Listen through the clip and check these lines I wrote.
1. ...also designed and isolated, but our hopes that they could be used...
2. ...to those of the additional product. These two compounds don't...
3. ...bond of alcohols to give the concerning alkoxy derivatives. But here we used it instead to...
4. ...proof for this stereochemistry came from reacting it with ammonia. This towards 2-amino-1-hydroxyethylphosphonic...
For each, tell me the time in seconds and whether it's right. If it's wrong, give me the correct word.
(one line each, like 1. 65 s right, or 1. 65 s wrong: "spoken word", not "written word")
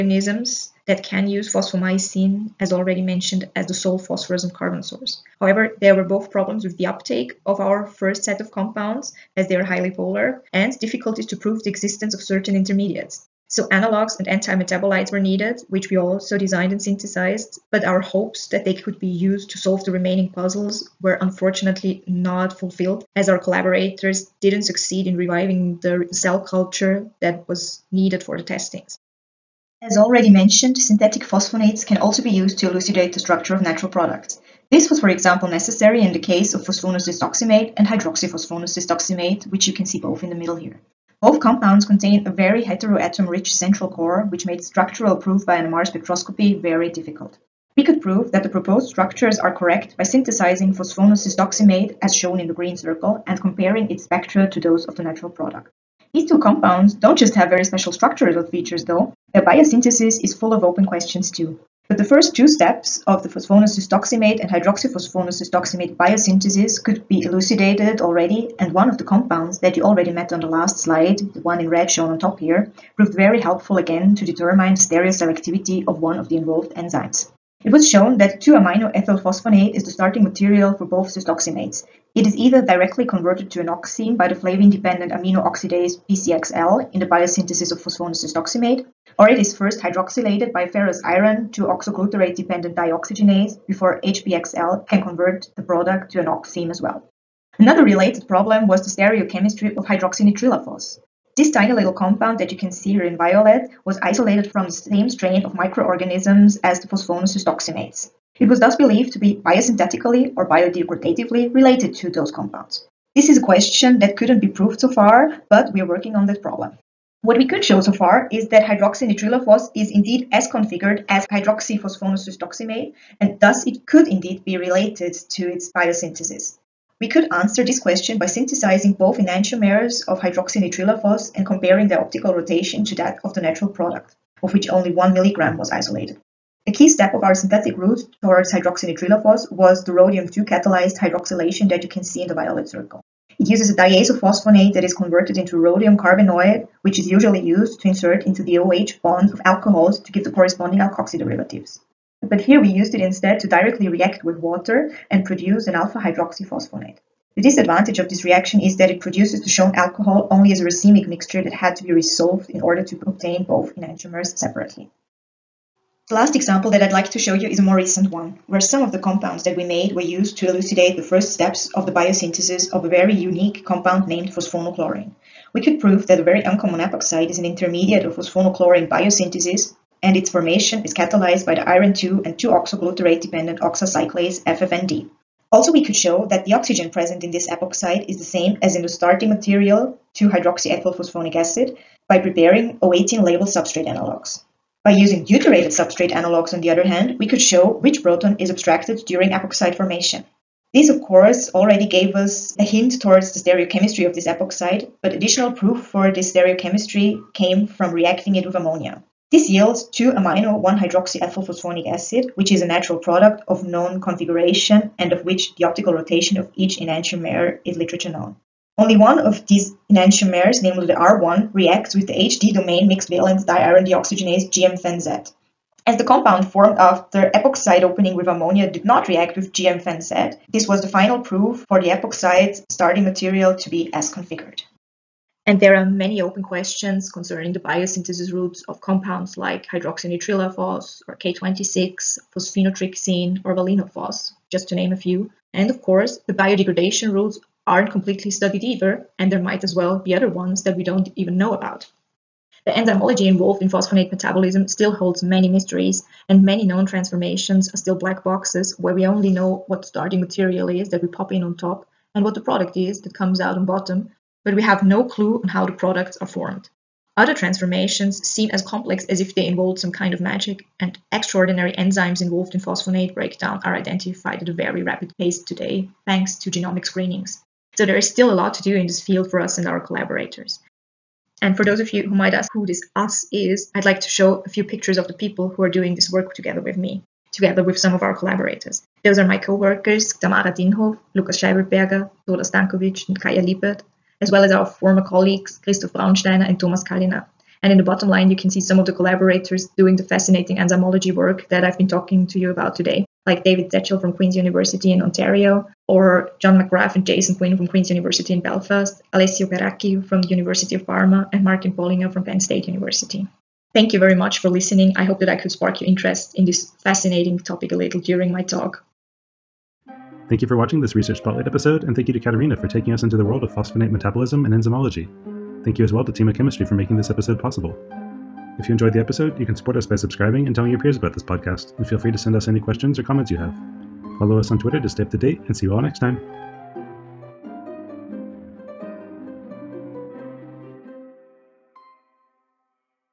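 1. 15 s wrong: "synthesized", not "isolated"
2. 54 s wrong: "natural", not "additional"
3. 149 s wrong: "corresponding", not "concerning"
4. 205 s wrong: "yields", not "towards".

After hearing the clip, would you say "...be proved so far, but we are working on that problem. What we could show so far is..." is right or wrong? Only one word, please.
right.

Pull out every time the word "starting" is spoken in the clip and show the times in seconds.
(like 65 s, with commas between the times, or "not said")
79 s, 188 s, 232 s, 259 s.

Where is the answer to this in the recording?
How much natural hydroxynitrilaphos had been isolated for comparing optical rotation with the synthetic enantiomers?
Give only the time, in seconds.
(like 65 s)
134 s.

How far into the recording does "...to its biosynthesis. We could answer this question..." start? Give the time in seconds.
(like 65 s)
125 s.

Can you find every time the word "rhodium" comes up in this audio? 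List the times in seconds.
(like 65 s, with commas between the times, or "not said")
139 s, 145 s.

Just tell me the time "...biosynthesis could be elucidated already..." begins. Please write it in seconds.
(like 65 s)
65 s.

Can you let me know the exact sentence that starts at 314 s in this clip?
I hope that I could spark your interest in this fascinating topic a little during my talk.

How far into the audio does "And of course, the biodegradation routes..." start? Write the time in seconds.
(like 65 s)
245 s.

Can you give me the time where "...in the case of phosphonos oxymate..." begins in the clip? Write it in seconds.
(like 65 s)
36 s.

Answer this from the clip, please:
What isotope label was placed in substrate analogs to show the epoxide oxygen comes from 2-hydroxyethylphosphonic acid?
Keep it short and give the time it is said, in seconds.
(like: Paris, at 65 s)
O18, at 192 s.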